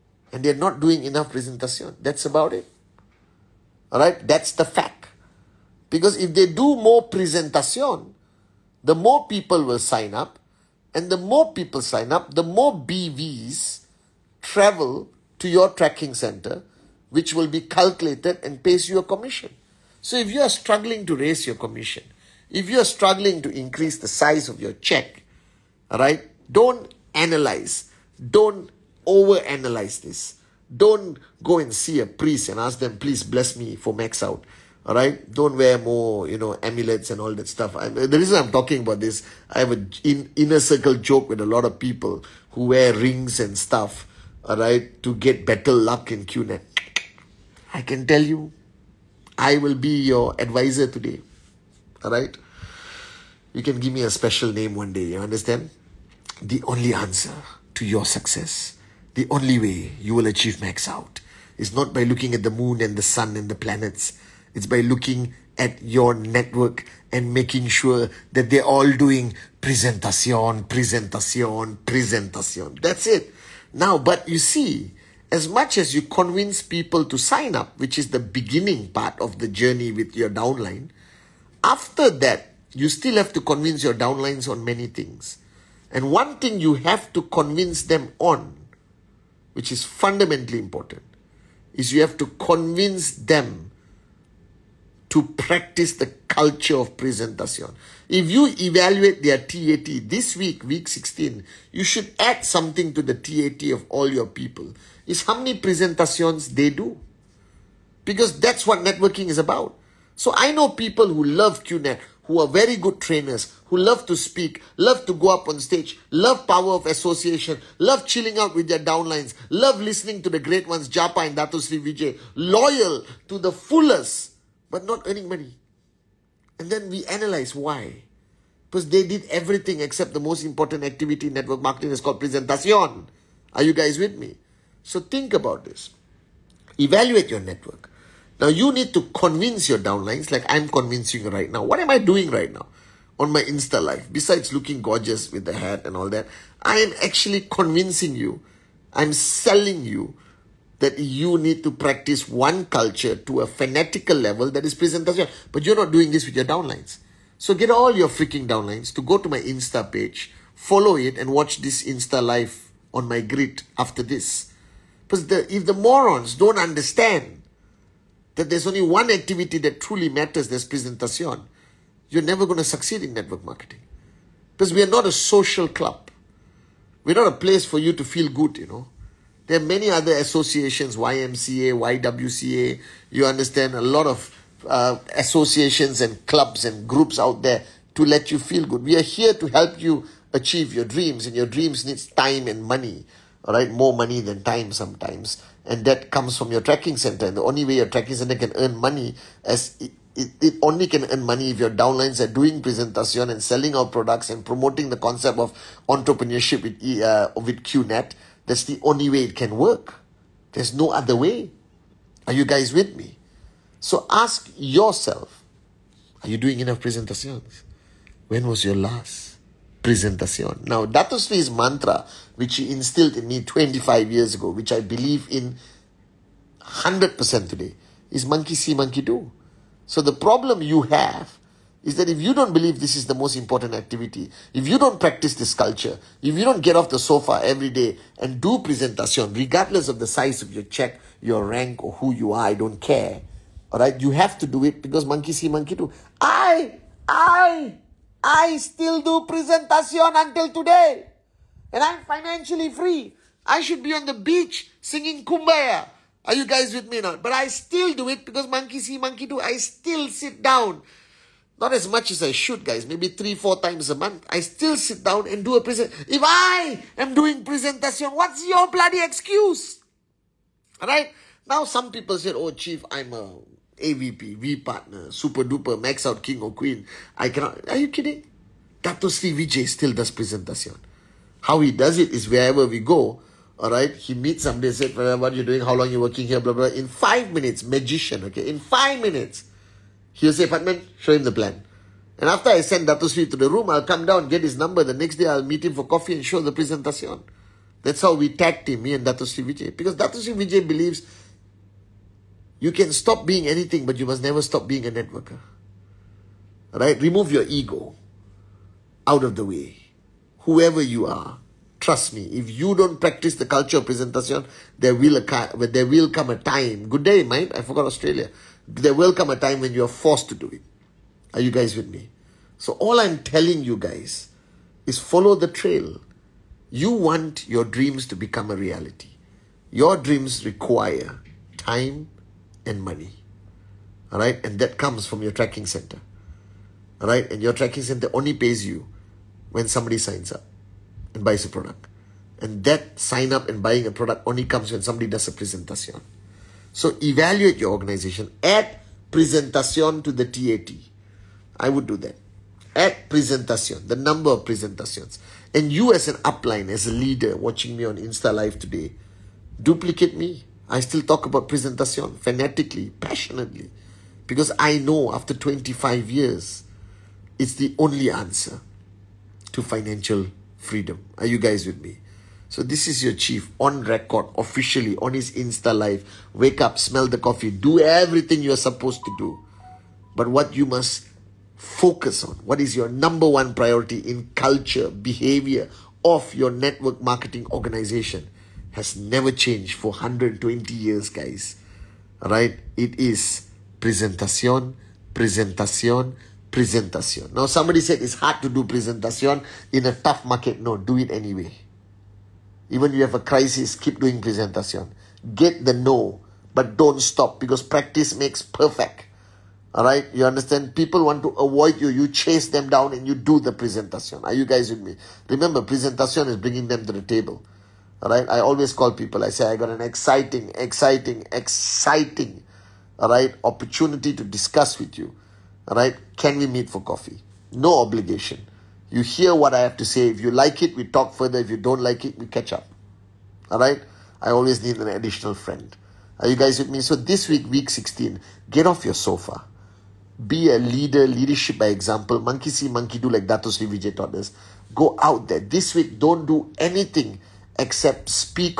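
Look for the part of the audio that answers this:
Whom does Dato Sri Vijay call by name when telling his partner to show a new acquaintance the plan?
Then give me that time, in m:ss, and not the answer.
4:50.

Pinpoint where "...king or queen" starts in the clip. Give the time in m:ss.
4:36.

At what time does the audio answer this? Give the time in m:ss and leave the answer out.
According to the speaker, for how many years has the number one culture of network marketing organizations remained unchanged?
6:29.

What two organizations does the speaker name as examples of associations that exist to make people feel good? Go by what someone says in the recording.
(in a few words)
YMCA, YWCA.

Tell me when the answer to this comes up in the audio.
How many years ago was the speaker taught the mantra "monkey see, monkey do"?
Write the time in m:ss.
3:43.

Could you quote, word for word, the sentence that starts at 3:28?
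That's the only way it can work.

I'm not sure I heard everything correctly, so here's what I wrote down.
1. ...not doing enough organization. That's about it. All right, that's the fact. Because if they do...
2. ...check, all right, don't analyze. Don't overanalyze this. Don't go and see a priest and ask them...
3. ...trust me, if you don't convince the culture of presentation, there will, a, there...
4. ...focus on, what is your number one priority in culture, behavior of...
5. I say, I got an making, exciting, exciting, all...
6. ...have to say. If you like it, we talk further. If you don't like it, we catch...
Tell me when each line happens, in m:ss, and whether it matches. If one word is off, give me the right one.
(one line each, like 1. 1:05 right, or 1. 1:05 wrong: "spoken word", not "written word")
1. 0:00 wrong: "presentation", not "organization"
2. 0:24 right
3. 5:11 wrong: "practice", not "convince"
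4. 6:21 right
5. 6:59 wrong: "exciting", not "making"
6. 7:09 right.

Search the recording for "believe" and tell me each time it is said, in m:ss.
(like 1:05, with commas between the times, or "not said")
3:44, 3:52, 5:00.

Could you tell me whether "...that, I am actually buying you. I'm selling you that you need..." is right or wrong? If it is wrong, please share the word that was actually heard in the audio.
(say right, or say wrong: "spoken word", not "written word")
wrong: "convincing", not "buying".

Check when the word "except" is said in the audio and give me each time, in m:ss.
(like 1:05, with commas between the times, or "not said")
2:09, 7:27.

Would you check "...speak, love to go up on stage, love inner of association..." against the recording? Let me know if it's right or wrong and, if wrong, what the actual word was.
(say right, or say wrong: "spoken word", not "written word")
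wrong: "power", not "inner".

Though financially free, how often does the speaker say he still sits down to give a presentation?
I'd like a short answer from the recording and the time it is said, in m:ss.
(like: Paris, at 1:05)
3 or 4 times a month, at 4:23.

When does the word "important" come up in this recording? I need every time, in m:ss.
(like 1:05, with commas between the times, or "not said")
1:30, 2:10, 3:53.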